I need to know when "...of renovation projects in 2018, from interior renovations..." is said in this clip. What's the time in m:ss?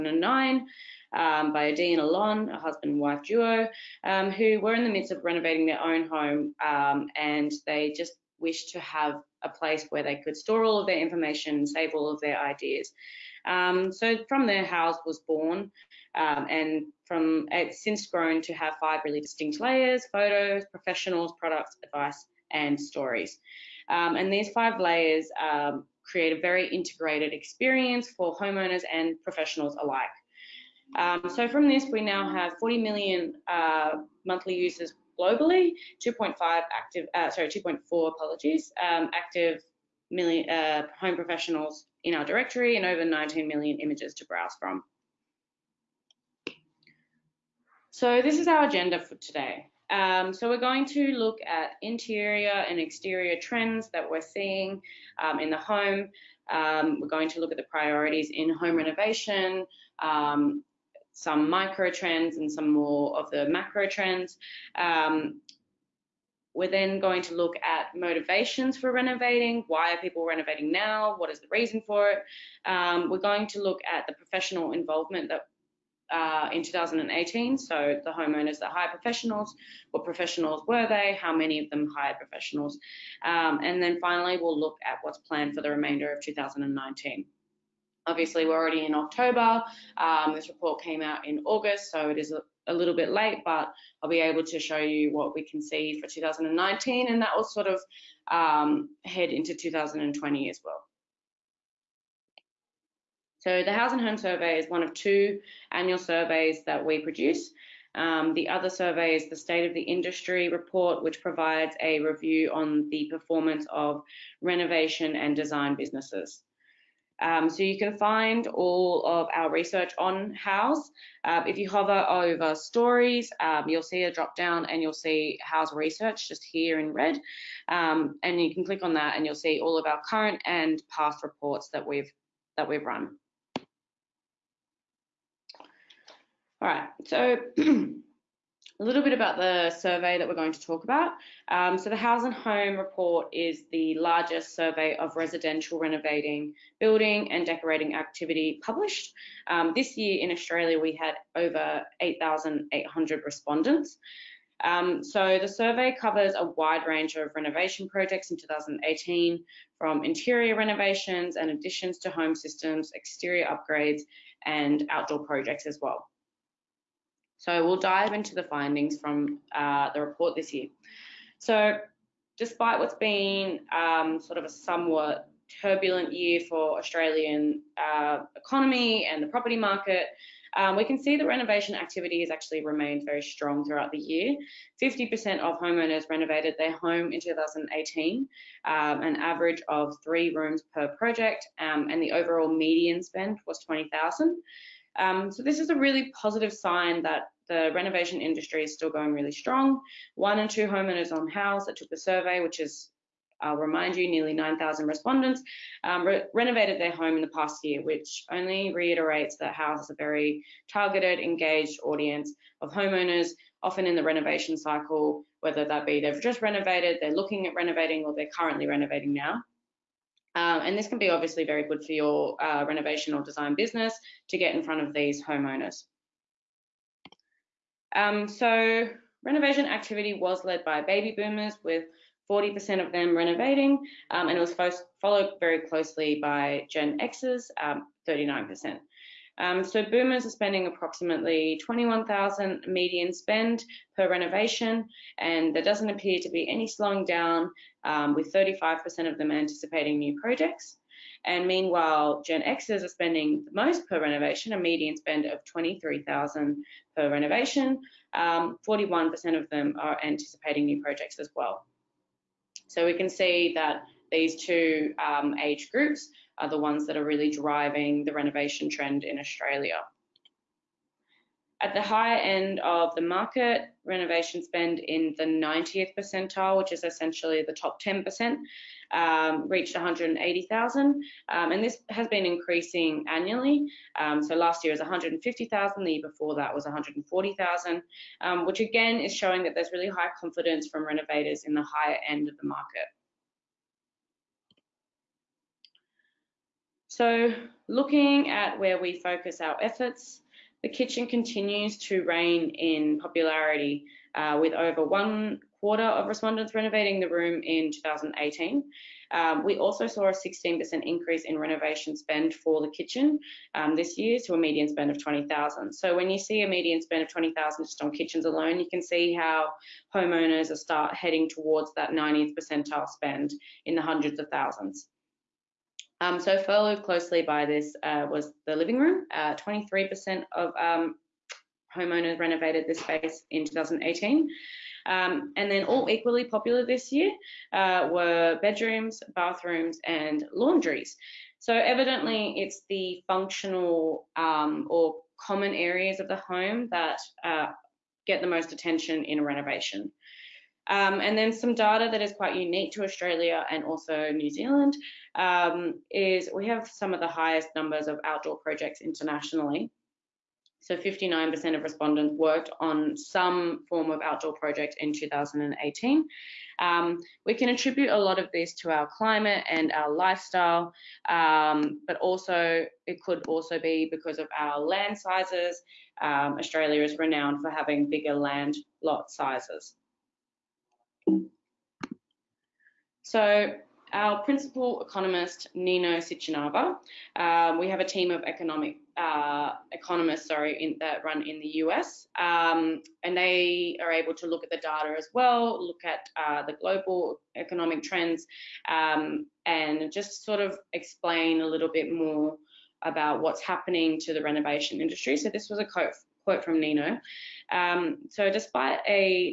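2:37.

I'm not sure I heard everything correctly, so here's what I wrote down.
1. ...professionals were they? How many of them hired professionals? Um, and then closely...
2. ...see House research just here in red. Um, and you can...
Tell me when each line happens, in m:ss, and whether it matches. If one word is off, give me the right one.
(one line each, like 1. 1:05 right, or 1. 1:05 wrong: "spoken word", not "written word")
1. 1:20 wrong: "finally", not "closely"
2. 2:04 right.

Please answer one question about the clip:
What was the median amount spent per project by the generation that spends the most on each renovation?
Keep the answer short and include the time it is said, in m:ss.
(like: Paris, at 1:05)
23,000, at 4:15.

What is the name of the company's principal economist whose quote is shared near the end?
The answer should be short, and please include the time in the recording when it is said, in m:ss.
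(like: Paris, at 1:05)
Nino Sitchinava, at 6:25.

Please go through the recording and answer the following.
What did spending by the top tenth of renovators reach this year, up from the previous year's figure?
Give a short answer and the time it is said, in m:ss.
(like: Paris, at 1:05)
180,000, at 4:39.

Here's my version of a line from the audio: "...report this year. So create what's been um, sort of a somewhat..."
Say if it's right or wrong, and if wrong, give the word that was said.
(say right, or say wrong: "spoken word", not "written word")
wrong: "despite", not "create".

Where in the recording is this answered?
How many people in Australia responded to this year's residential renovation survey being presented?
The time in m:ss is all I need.
2:31.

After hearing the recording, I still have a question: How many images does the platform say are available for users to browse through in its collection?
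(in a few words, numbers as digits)
over 19 million.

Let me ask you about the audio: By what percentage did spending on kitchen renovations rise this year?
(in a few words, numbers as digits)
16%.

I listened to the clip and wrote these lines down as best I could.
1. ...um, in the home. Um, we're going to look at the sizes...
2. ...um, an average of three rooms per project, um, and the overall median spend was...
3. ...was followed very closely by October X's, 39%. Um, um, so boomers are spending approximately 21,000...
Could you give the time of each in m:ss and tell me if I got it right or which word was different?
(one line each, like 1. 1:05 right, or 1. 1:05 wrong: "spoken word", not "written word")
1. 0:55 wrong: "priorities", not "sizes"
2. 3:08 right
3. 3:54 wrong: "Gen", not "October".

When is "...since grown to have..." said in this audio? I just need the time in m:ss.
0:17.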